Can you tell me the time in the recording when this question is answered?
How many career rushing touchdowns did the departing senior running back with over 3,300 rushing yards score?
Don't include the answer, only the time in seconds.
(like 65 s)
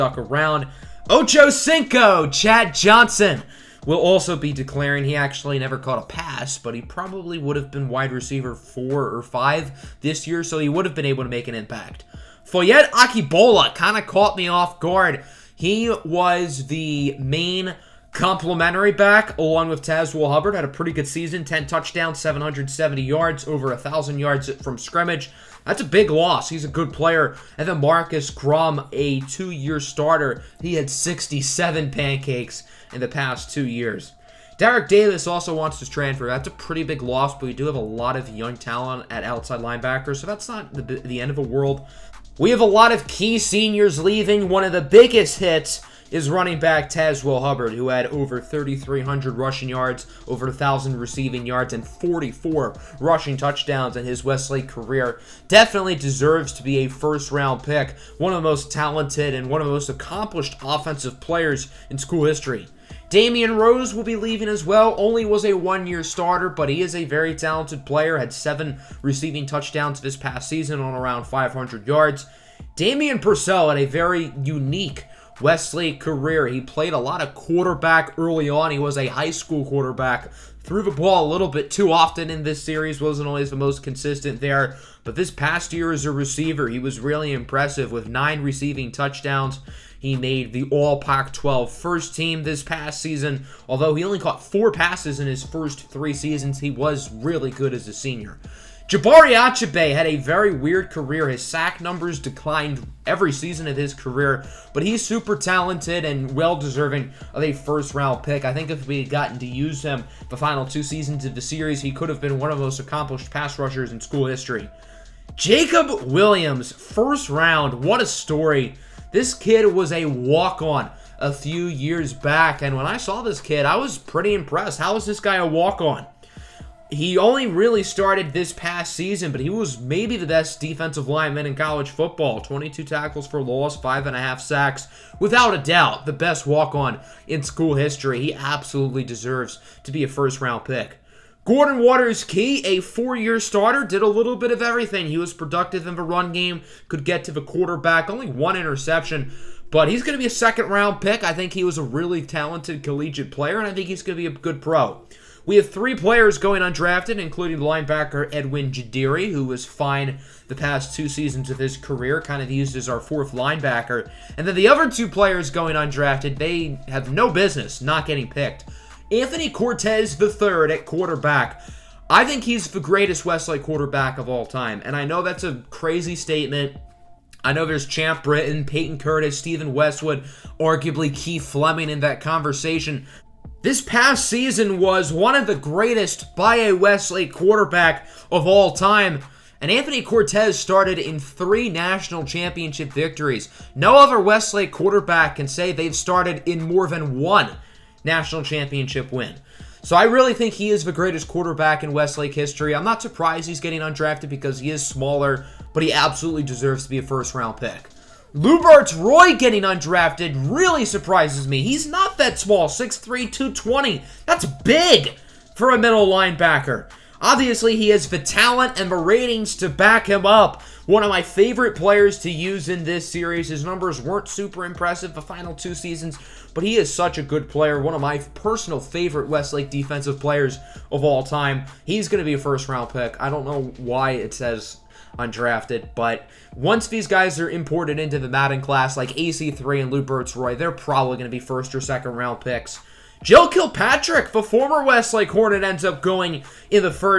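51 s.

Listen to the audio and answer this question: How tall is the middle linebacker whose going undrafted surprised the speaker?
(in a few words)
6'3".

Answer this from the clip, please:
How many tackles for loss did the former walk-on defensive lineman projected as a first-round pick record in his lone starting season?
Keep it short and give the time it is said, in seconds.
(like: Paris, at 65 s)
22, at 132 s.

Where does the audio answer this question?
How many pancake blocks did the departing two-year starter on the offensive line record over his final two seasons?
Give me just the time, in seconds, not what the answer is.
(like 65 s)
30 s.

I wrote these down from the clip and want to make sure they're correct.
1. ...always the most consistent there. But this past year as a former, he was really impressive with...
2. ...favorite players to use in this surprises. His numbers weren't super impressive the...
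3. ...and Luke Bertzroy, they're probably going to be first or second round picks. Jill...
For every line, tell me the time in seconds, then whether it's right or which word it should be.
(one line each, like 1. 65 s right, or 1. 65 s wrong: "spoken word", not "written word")
1. 83 s wrong: "receiver", not "former"
2. 221 s wrong: "series", not "surprises"
3. 239 s right.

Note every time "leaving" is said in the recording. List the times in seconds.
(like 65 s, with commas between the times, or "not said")
44 s, 64 s.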